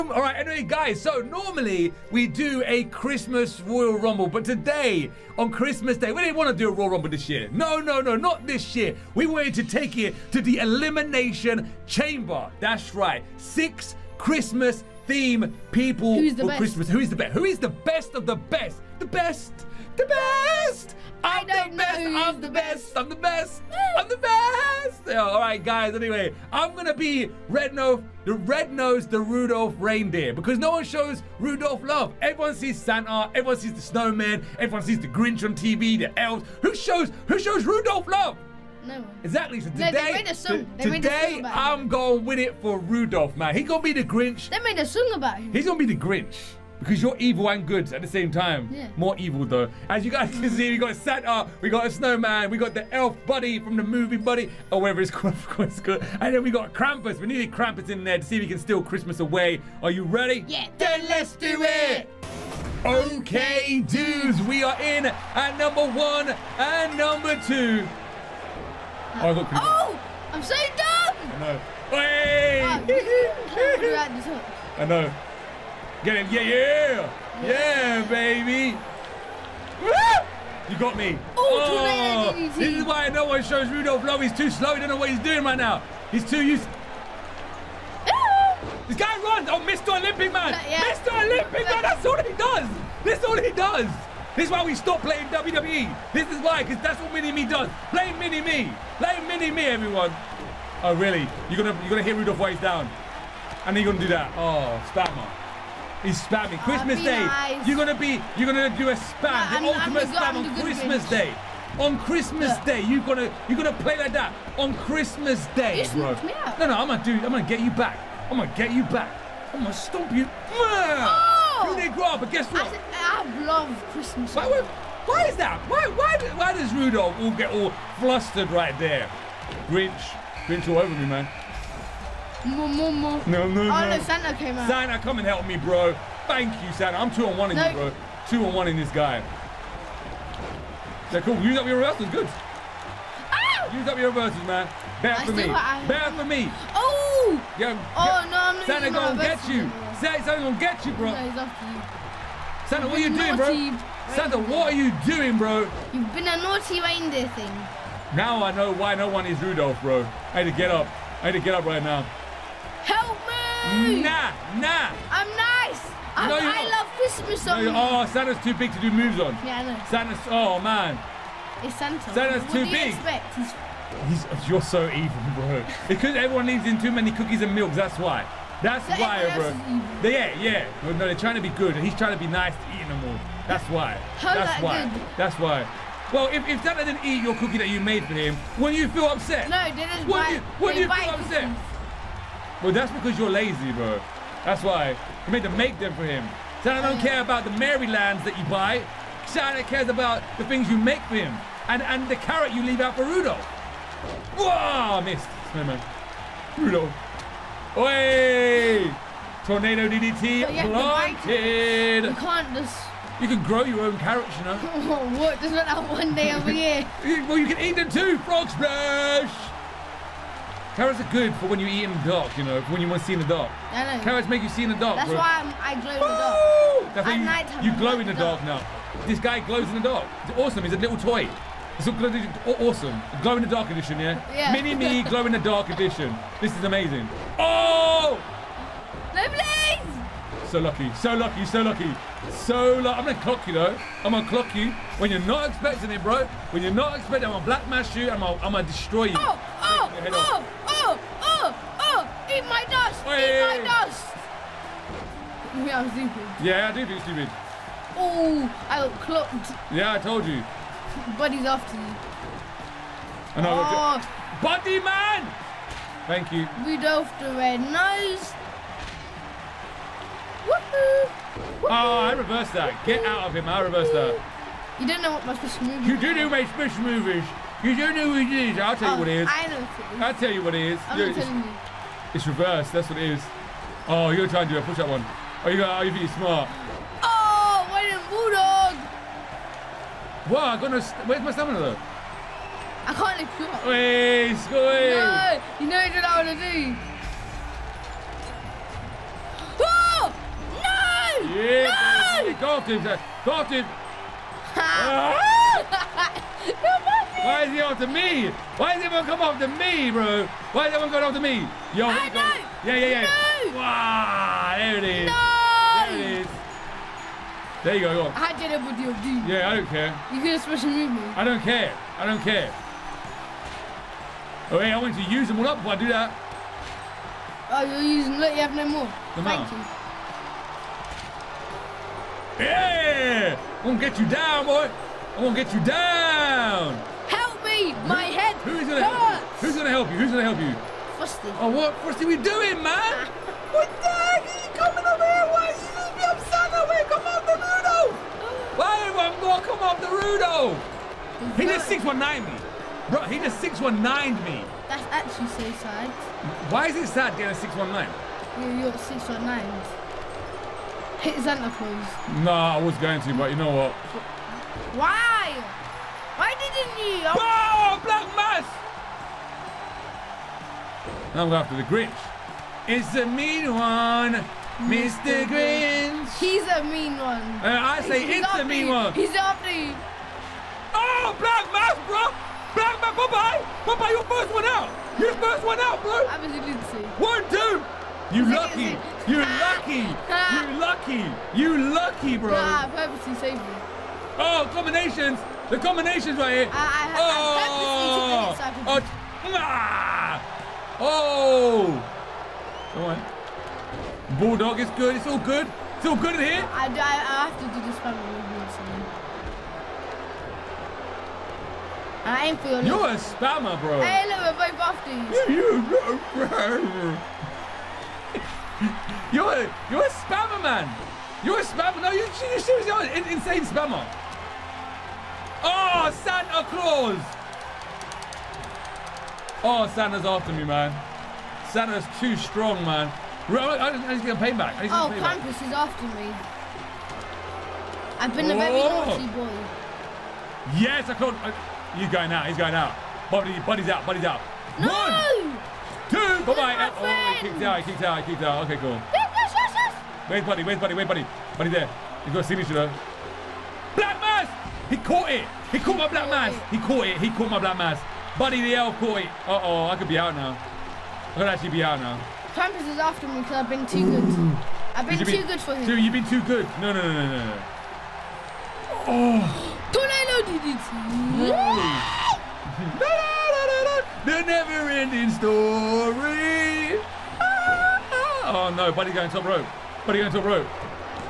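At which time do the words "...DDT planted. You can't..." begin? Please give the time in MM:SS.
03:29.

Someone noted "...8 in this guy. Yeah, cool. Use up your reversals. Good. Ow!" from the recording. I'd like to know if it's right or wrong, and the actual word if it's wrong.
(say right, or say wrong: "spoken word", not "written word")
wrong: "1", not "8".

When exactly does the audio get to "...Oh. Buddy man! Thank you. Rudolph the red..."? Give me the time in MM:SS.
04:24.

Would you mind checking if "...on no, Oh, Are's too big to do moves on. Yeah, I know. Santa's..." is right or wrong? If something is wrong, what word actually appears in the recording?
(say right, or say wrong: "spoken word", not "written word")
wrong: "Santa", not "Are".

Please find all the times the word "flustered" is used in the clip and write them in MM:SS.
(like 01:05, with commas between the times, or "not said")
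02:07.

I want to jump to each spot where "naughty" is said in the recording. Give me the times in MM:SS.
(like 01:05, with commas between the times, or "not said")
02:36, 07:18.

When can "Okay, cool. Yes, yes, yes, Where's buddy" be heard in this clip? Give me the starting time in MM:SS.
07:28.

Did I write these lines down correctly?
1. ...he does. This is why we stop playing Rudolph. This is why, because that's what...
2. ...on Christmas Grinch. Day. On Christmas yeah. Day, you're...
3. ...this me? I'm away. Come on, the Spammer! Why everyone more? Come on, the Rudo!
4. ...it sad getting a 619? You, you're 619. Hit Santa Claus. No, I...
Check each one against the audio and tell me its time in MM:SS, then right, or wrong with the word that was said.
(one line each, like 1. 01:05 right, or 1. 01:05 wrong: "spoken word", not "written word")
1. 01:33 wrong: "WWE", not "Rudolph"
2. 01:50 right
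3. 05:45 wrong: "Rudo", not "Spammer"
4. 05:56 right.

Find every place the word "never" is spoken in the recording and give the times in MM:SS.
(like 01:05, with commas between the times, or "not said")
07:54.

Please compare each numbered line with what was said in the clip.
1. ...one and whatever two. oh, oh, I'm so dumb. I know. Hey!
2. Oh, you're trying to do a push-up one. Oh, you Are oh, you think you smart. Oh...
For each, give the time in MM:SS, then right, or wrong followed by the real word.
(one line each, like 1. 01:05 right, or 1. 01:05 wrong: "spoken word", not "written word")
1. 01:05 wrong: "number", not "whatever"
2. 04:43 right.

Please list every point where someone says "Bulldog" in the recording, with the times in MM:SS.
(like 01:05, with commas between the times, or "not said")
04:48, 06:44.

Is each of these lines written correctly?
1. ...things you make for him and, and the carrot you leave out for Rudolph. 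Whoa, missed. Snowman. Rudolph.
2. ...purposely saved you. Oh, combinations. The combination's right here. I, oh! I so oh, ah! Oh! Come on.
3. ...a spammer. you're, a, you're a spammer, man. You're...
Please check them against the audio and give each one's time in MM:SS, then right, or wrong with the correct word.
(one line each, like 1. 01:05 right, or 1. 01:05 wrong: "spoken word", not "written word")
1. 03:20 right
2. 06:32 right
3. 06:55 right.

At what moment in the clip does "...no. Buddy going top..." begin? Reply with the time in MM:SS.
07:58.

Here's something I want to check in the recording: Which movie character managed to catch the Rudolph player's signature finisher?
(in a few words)
Buddy the elf.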